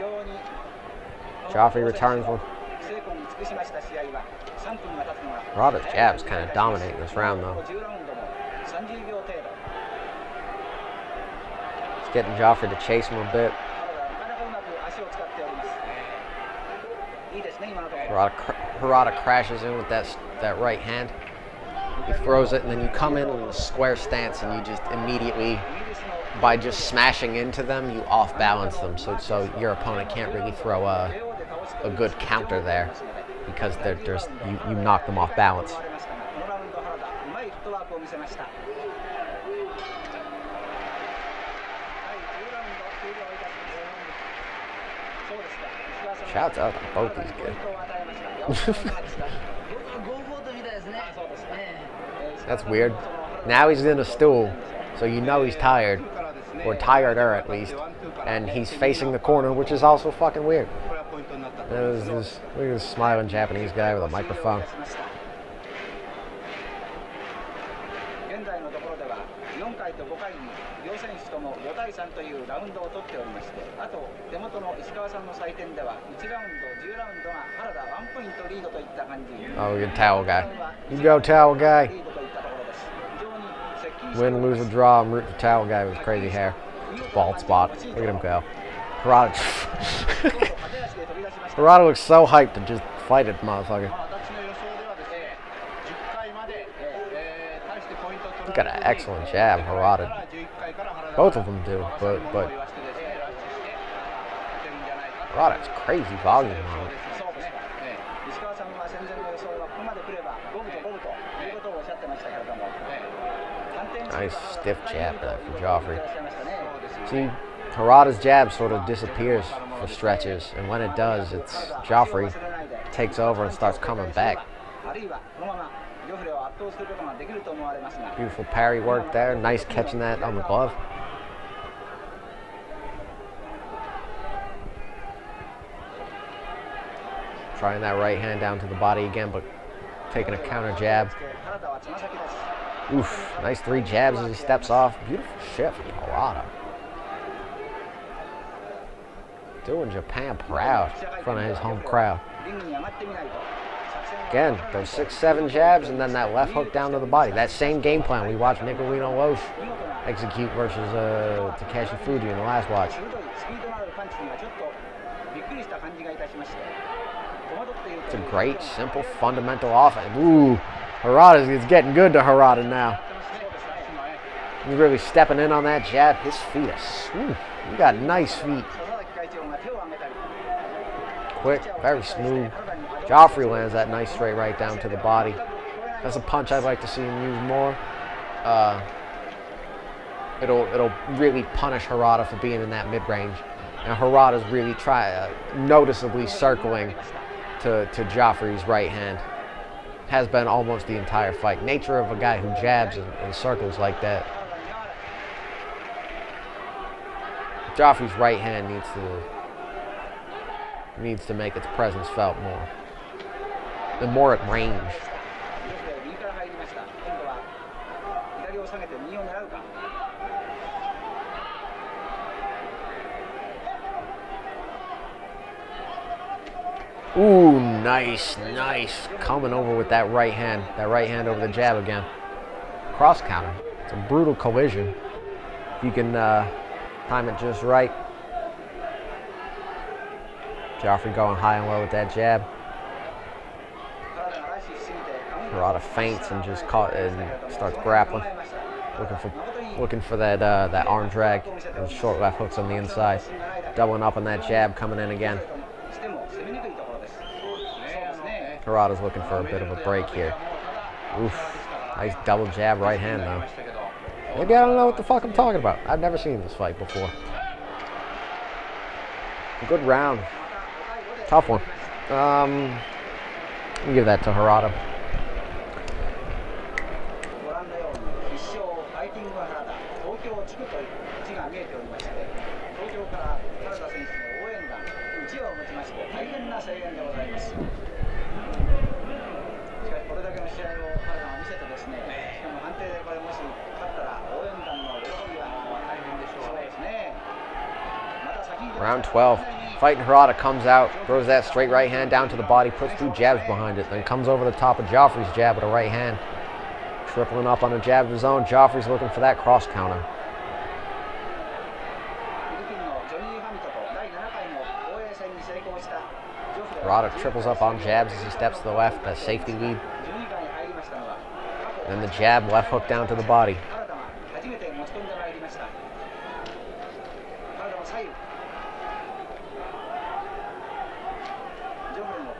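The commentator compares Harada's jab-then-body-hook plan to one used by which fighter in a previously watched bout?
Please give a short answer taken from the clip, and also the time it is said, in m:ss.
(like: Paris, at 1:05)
Nicolino Locche, at 2:38.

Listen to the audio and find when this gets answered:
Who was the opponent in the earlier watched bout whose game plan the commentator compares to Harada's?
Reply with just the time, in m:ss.
2:41.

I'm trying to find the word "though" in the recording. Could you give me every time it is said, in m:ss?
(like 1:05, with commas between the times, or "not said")
0:07, 4:23.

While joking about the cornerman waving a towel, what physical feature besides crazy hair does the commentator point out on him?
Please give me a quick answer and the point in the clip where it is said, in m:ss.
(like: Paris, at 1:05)
Bald spot, at 1:27.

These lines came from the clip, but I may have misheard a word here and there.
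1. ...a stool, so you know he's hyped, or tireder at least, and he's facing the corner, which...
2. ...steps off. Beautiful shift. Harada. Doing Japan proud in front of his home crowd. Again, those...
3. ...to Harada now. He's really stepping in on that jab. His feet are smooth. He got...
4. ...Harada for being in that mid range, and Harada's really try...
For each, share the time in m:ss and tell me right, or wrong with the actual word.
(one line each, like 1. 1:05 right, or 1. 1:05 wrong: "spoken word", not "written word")
1. 0:53 wrong: "tired", not "hyped"
2. 2:24 right
3. 2:52 right
4. 3:11 right.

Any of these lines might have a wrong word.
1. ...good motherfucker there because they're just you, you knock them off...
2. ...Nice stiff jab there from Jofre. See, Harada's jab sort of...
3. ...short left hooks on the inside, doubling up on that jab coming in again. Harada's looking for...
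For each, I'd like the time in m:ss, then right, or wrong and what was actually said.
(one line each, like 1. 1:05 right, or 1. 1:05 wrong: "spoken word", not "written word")
1. 0:31 wrong: "counter", not "motherfucker"
2. 1:54 right
3. 4:11 right.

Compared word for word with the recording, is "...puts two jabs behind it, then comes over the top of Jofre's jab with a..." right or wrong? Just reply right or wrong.
right.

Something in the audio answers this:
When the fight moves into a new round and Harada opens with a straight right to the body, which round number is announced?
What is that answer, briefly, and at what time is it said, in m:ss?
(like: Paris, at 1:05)
12, at 4:58.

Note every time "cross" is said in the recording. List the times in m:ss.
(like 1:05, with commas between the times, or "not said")
3:52, 5:09.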